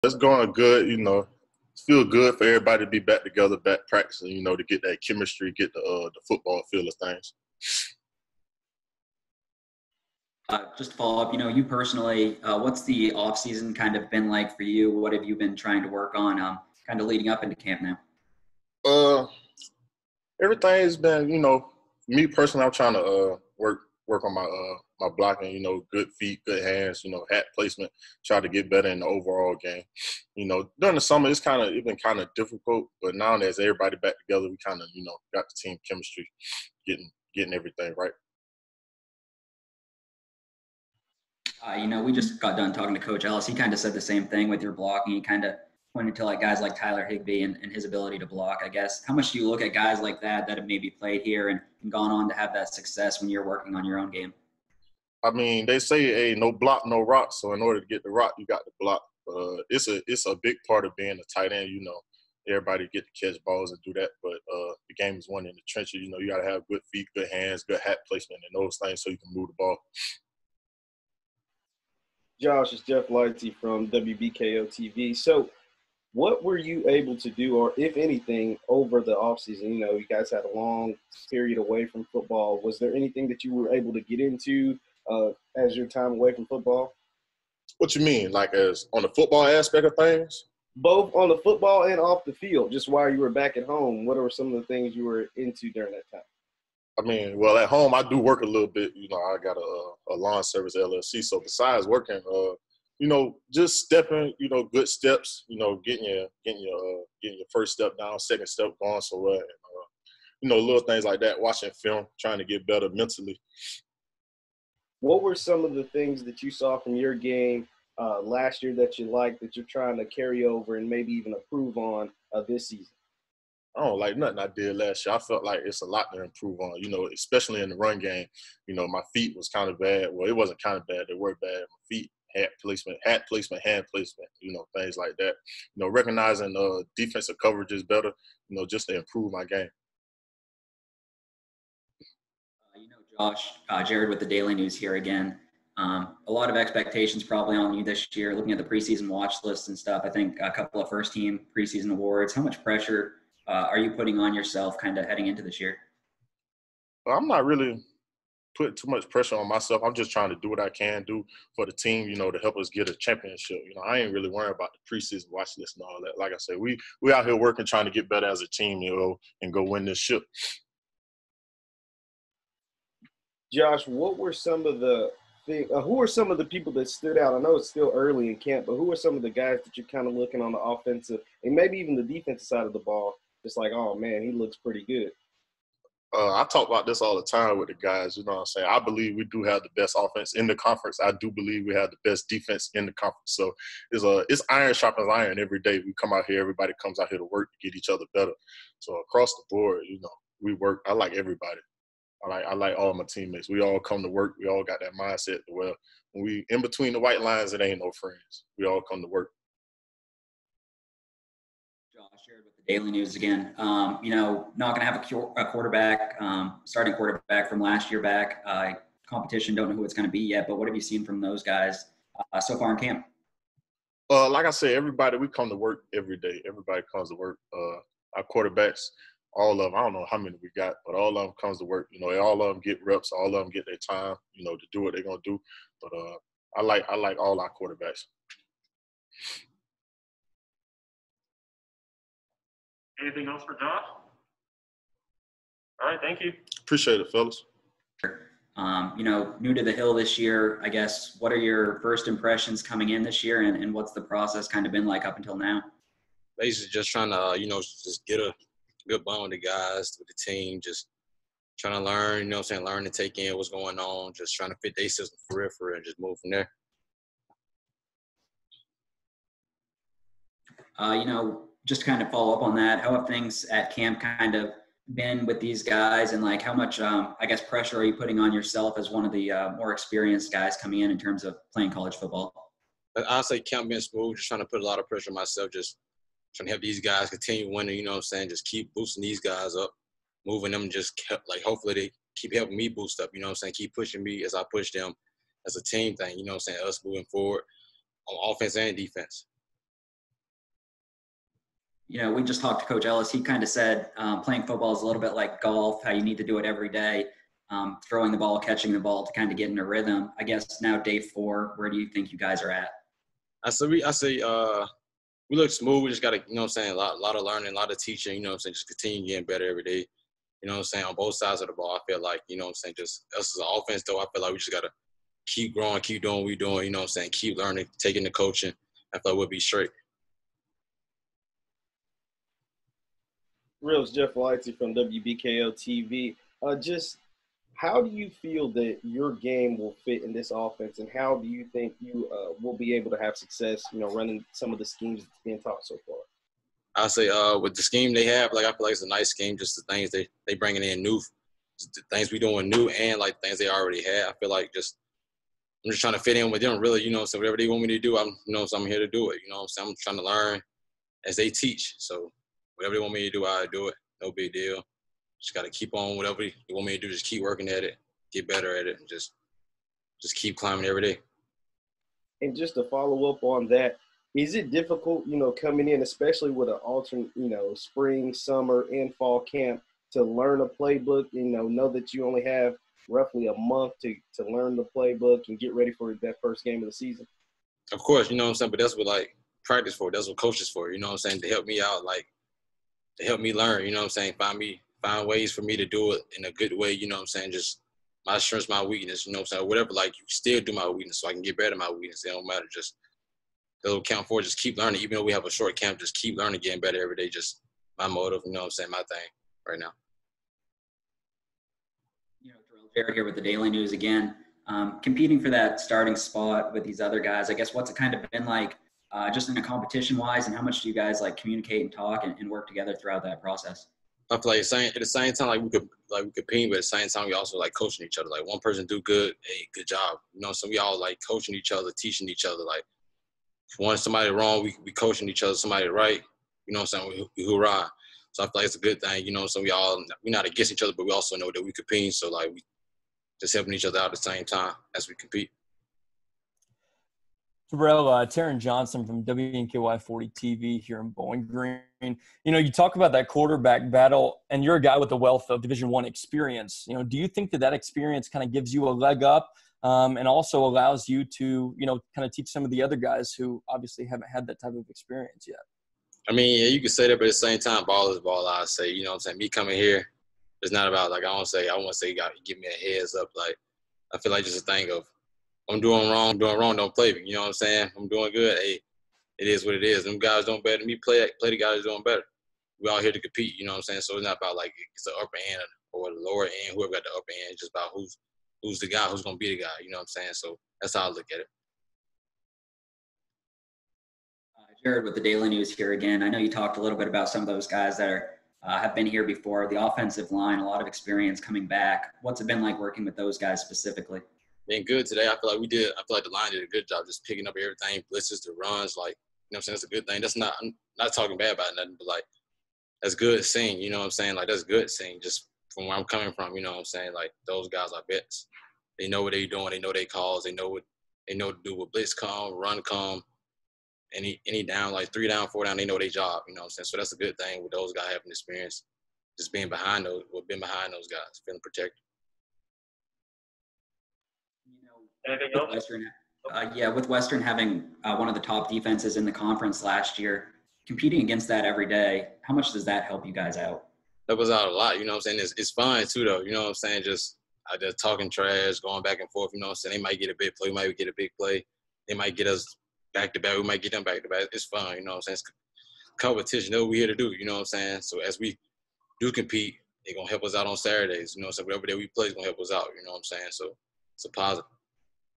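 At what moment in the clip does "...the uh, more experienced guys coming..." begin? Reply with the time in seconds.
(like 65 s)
279 s.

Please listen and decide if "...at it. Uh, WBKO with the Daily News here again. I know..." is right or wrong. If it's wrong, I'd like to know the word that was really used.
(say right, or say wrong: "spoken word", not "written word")
wrong: "Jared", not "WBKO".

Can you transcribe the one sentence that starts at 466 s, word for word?
I mean, yeah, you could say that, but at the same time, ball is ball.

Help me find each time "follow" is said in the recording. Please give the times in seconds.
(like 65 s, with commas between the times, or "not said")
10 s, 272 s, 372 s.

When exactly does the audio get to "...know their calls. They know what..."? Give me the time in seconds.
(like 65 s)
519 s.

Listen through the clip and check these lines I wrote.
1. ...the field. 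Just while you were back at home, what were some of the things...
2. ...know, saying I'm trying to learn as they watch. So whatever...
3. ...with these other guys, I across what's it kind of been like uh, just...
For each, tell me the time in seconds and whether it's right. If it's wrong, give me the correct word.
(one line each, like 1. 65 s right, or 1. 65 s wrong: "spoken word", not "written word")
1. 92 s right
2. 359 s wrong: "teach", not "watch"
3. 416 s wrong: "guess", not "across".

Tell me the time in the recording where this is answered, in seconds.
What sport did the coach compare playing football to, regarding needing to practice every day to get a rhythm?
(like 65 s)
305 s.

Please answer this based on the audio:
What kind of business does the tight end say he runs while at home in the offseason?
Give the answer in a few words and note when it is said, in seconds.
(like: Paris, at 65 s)
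Lawn service LLC, at 100 s.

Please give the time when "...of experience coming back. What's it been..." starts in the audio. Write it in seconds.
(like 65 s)
500 s.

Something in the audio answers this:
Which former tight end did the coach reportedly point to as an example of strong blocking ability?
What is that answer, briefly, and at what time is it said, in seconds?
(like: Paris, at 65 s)
Tyler Higbee, at 46 s.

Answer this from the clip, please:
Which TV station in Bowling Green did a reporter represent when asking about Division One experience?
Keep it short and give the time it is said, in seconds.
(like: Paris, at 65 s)
WNKY 40, at 449 s.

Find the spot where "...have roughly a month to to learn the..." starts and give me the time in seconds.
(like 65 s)
382 s.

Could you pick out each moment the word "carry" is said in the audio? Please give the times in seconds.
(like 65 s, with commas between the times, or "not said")
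120 s.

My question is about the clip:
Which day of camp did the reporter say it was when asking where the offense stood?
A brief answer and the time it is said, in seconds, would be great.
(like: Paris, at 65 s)
Day four, at 310 s.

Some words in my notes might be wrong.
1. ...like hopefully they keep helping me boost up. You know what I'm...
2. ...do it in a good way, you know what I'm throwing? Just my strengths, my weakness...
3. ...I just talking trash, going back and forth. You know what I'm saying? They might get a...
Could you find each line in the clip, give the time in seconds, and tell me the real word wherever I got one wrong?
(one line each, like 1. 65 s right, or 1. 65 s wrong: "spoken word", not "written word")
1. 291 s right
2. 395 s wrong: "saying", not "throwing"
3. 547 s right.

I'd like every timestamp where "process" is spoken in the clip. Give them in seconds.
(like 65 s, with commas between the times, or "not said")
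254 s, 423 s.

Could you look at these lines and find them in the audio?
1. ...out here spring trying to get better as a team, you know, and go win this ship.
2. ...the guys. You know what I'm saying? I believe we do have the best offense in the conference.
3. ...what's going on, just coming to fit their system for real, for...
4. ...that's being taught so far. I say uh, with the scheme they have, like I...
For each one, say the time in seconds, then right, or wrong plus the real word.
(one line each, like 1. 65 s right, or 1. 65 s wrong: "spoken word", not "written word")
1. 167 s wrong: "working", not "spring"
2. 187 s right
3. 263 s wrong: "trying", not "coming"
4. 345 s right.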